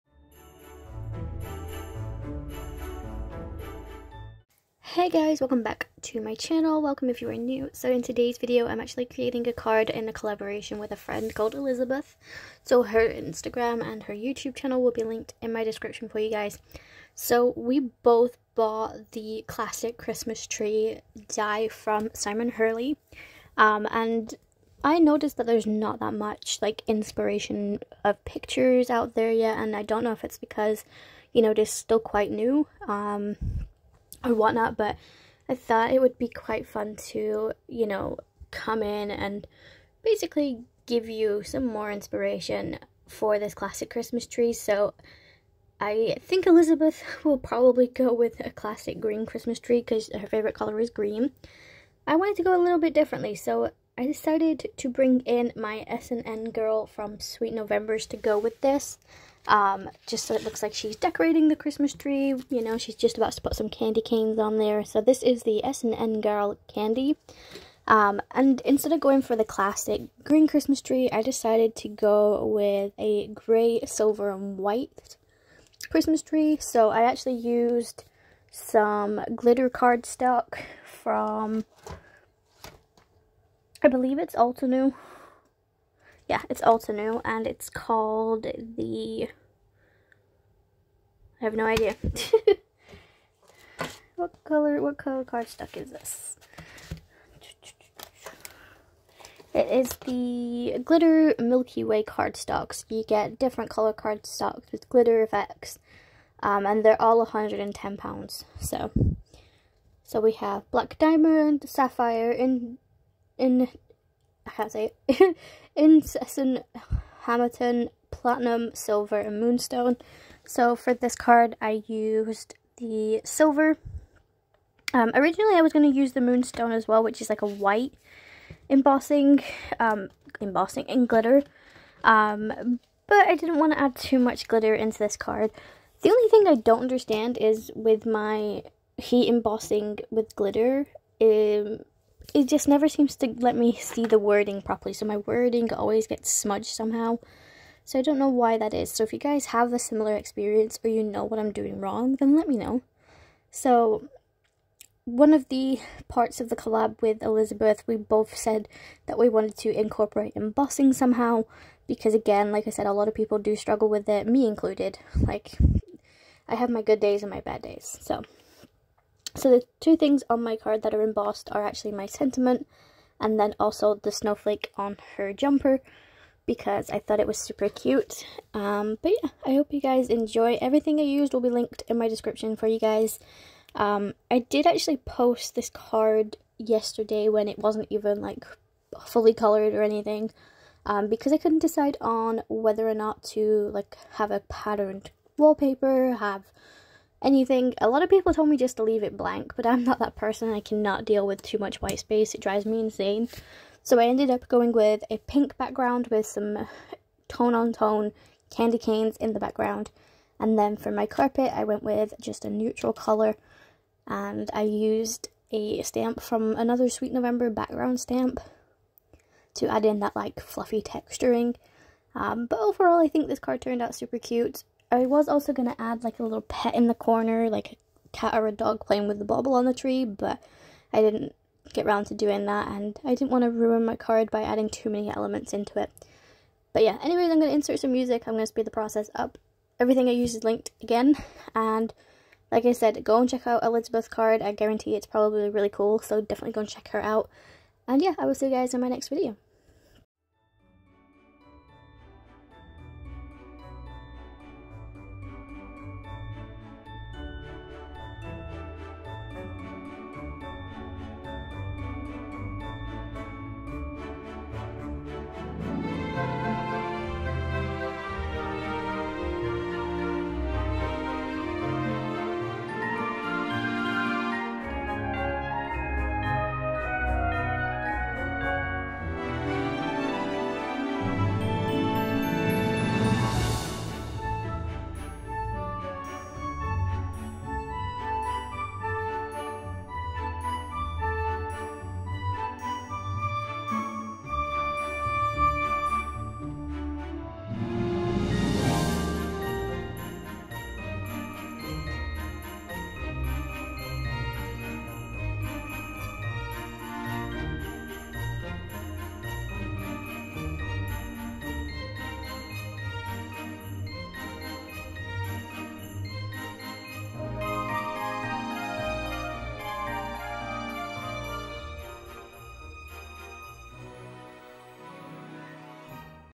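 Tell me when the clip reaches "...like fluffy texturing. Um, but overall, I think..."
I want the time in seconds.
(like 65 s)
220 s.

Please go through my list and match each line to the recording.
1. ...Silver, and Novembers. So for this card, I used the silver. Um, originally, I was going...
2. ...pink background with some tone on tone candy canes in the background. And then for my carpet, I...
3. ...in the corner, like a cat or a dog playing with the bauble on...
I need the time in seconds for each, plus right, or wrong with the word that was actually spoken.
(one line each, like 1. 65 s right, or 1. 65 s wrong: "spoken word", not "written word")
1. 118 s wrong: "Moonstone", not "Novembers"
2. 205 s right
3. 226 s right.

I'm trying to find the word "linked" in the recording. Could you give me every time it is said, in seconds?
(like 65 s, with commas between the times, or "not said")
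15 s, 181 s, 240 s.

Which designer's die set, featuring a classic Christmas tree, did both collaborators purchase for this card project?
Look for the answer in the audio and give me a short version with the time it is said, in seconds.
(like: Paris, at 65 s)
Simon Hurley, at 22 s.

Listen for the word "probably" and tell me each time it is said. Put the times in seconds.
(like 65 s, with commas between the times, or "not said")
47 s, 245 s.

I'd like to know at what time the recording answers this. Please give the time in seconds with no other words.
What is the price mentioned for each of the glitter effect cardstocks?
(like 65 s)
107 s.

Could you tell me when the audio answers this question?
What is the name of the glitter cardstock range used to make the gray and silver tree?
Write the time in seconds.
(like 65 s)
100 s.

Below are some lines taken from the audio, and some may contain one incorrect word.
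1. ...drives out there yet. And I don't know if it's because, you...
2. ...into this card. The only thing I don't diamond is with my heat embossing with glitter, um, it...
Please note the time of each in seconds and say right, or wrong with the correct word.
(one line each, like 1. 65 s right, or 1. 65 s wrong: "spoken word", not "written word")
1. 28 s wrong: "pictures", not "drives"
2. 134 s wrong: "understand", not "diamond".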